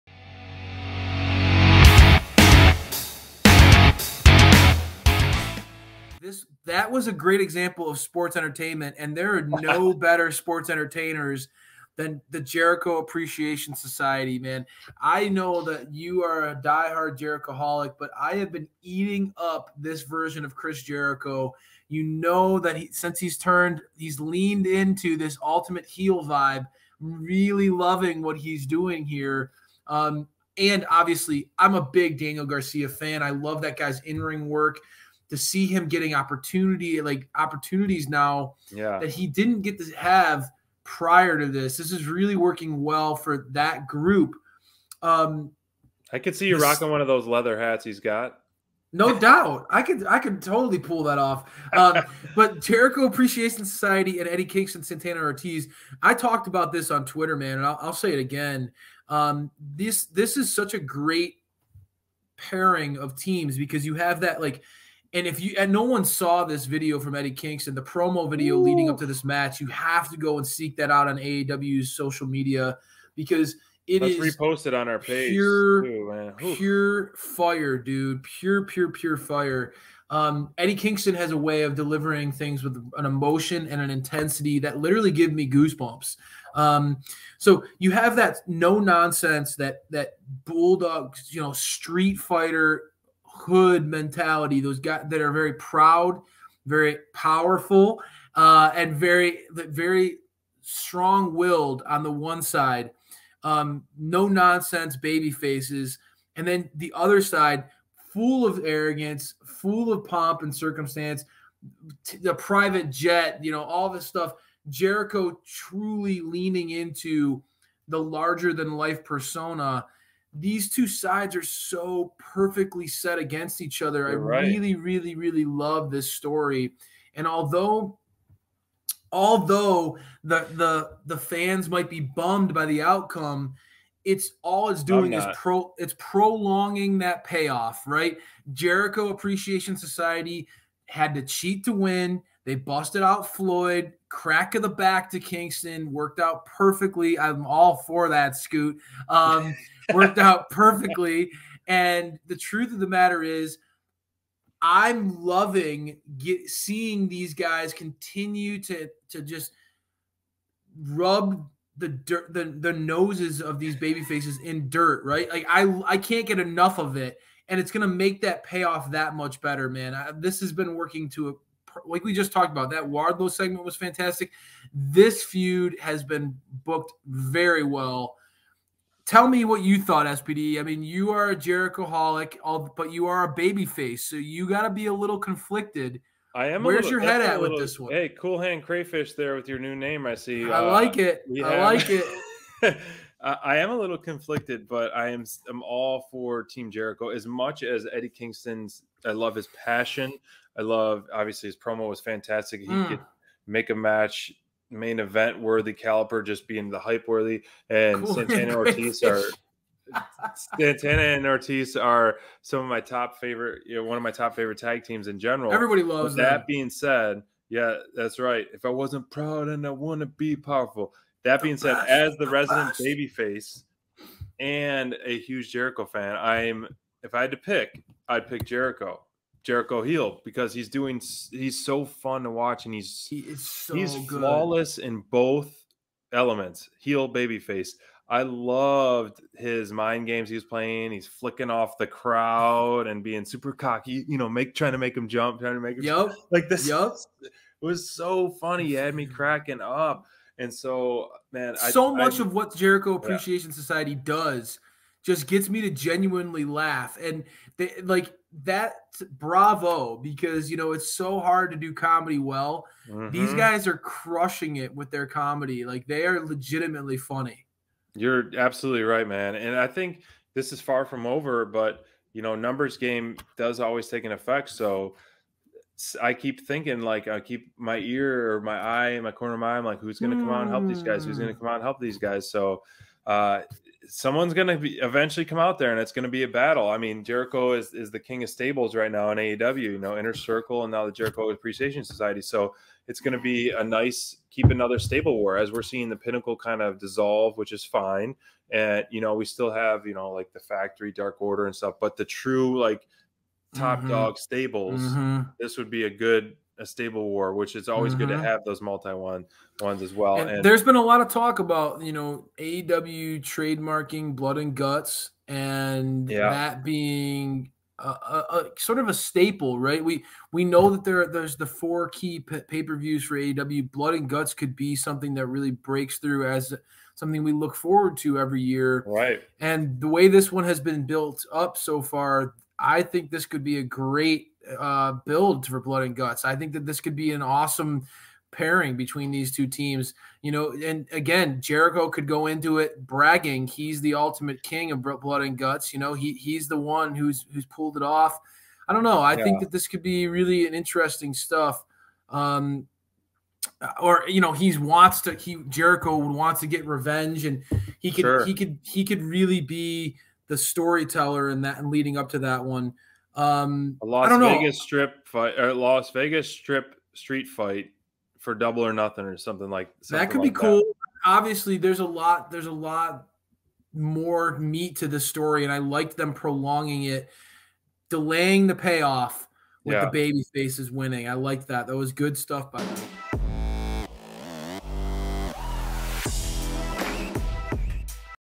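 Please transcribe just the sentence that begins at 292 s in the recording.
So it's going to be a nice keep another stable war as we're seeing the pinnacle kind of dissolve, which is fine.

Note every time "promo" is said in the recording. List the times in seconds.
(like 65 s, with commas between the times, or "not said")
67 s, 201 s.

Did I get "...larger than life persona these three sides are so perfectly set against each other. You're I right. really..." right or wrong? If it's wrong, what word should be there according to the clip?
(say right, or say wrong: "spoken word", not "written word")
wrong: "two", not "three".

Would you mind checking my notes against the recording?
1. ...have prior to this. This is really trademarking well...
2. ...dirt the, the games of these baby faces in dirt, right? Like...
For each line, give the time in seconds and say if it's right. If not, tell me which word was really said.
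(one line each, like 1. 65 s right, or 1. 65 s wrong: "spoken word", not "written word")
1. 39 s wrong: "working", not "trademarking"
2. 161 s wrong: "noses", not "games".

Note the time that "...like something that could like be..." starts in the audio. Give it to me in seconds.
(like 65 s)
369 s.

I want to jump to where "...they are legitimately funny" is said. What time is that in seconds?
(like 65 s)
265 s.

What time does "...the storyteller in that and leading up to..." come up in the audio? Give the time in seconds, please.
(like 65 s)
360 s.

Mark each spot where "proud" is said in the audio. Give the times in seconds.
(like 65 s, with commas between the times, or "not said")
95 s, 219 s.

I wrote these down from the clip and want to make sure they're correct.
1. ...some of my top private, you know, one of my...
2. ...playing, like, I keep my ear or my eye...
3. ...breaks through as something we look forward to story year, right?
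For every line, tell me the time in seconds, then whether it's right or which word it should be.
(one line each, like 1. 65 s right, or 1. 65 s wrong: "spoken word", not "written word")
1. 212 s wrong: "favorite", not "private"
2. 276 s wrong: "thinking", not "playing"
3. 325 s wrong: "every", not "story".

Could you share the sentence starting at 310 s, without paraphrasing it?
And, and there's been a lot of talk about you know AEW trademarking blood and guts, and yeah.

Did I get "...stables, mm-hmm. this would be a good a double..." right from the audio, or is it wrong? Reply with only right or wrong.
wrong.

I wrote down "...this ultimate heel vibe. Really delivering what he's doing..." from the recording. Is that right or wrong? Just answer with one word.
wrong.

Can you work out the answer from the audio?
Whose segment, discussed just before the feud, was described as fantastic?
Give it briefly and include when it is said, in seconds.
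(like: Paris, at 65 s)
Wardlow, at 172 s.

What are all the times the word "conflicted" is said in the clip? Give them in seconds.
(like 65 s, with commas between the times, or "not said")
185 s, 193 s.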